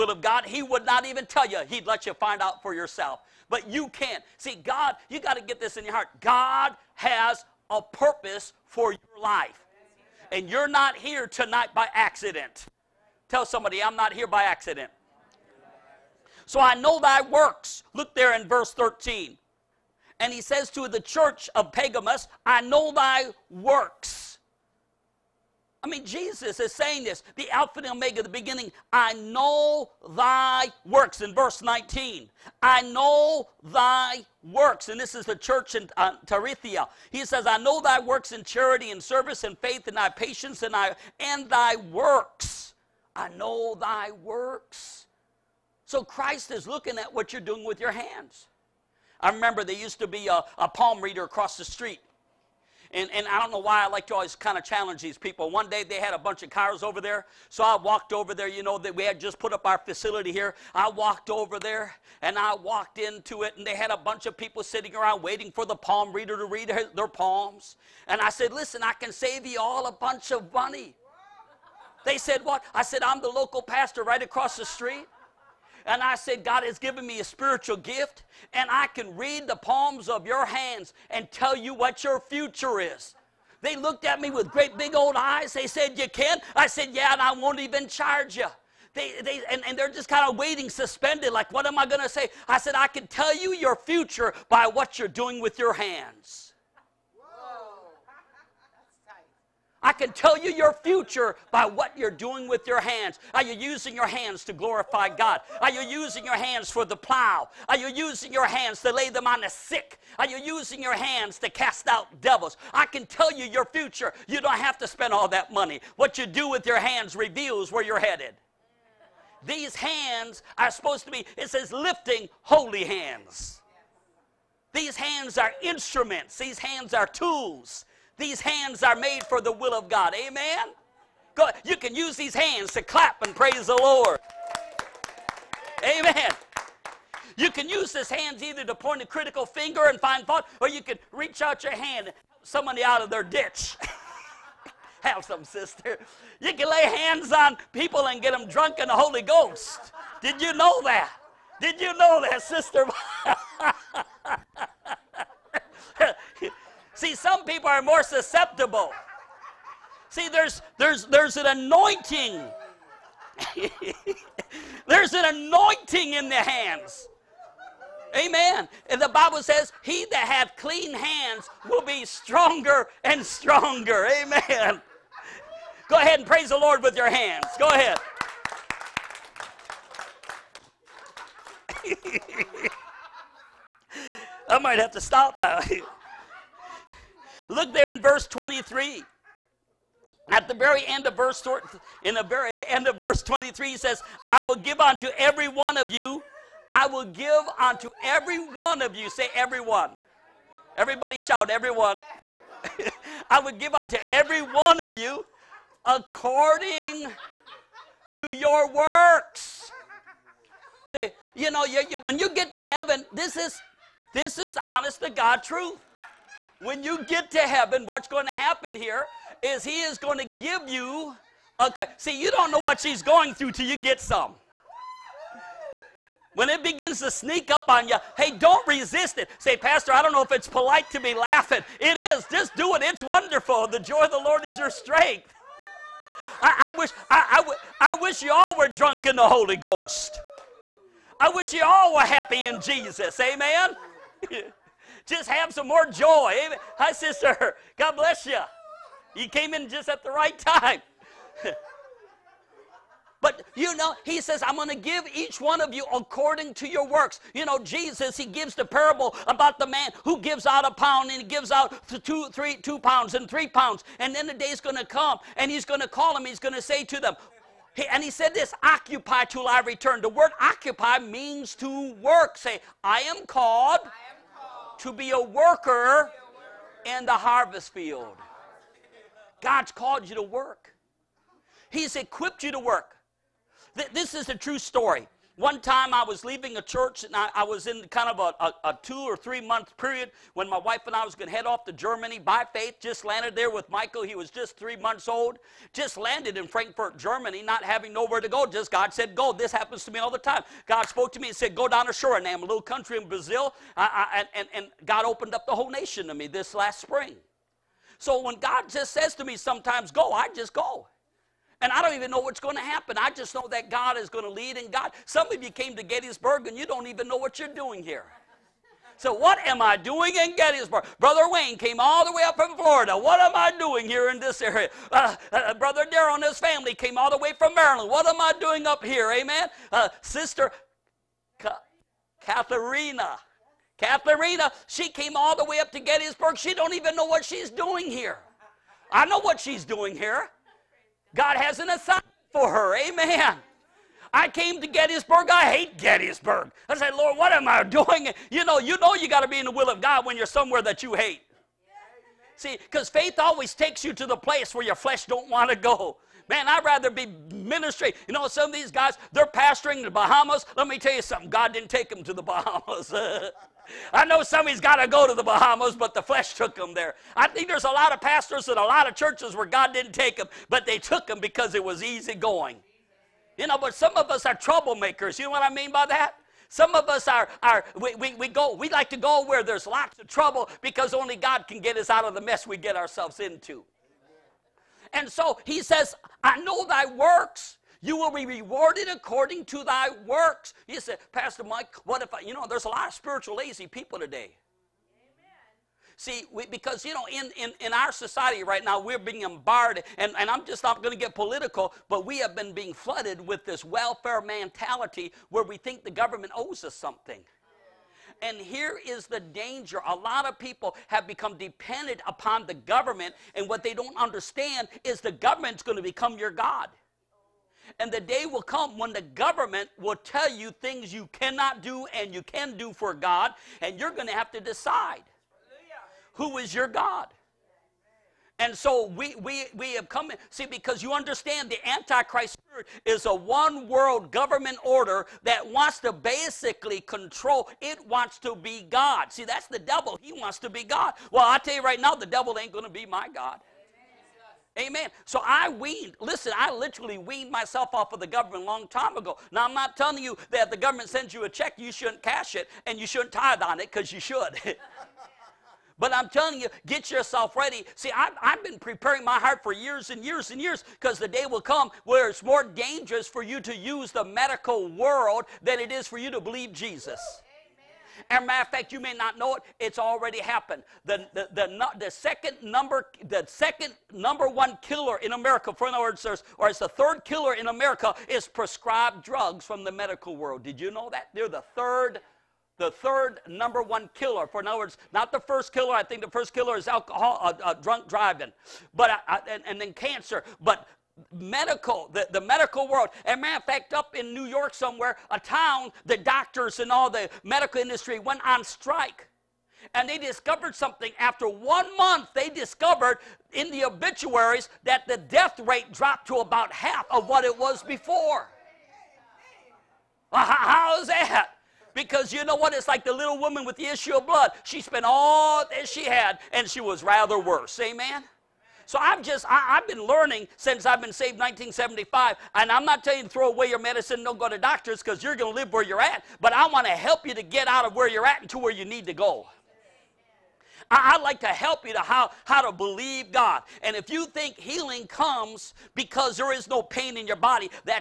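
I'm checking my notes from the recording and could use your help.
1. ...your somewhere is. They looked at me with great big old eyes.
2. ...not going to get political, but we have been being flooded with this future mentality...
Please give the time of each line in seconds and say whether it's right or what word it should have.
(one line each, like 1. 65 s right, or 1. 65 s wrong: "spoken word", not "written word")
1. 82 s wrong: "future", not "somewhere"
2. 400 s wrong: "welfare", not "future".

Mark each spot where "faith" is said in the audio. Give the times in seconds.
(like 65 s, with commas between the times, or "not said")
39 s, 292 s, 352 s.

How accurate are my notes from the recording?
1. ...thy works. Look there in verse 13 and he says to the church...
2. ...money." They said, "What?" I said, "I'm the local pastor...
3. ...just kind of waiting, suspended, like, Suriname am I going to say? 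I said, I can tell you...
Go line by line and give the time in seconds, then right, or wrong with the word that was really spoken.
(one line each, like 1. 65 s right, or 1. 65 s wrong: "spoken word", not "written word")
1. 16 s right
2. 70 s right
3. 89 s wrong: "What", not "Suriname".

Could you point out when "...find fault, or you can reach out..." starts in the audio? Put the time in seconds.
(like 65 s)
140 s.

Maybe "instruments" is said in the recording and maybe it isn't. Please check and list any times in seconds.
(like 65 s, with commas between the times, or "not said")
125 s.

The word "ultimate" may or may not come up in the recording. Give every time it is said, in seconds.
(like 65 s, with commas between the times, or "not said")
not said.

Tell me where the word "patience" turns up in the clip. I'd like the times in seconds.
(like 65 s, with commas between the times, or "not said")
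40 s.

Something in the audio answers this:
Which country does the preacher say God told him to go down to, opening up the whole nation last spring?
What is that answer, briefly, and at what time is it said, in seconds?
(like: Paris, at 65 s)
Suriname, at 301 s.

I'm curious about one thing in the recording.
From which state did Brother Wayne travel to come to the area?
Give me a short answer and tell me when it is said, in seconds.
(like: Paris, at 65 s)
Florida, at 322 s.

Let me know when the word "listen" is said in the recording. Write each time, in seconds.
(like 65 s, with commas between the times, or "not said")
68 s, 446 s.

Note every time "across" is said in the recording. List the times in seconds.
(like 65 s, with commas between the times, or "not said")
51 s, 74 s.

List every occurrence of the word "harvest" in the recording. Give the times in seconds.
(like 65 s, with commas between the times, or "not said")
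277 s.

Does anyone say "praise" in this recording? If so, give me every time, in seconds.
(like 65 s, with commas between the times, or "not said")
133 s, 176 s.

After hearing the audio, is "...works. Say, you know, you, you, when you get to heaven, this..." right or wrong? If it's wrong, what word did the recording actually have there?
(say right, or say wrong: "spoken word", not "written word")
right.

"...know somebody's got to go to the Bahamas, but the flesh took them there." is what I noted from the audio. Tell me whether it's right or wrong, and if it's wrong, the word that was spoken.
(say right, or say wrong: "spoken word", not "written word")
right.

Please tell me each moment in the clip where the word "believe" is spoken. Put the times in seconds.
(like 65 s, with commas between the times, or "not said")
466 s, 532 s.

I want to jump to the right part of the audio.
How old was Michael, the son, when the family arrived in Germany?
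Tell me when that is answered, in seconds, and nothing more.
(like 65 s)
294 s.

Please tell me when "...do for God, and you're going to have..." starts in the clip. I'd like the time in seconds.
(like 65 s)
422 s.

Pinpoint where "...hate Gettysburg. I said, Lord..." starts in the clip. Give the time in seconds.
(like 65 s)
345 s.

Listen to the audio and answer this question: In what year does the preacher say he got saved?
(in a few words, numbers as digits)
1975.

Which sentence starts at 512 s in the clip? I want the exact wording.
It's like the little woman with the issue of blood.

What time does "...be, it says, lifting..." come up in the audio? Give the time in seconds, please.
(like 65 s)
121 s.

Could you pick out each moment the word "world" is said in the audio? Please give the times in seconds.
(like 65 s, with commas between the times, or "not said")
433 s, 464 s, 480 s, 492 s.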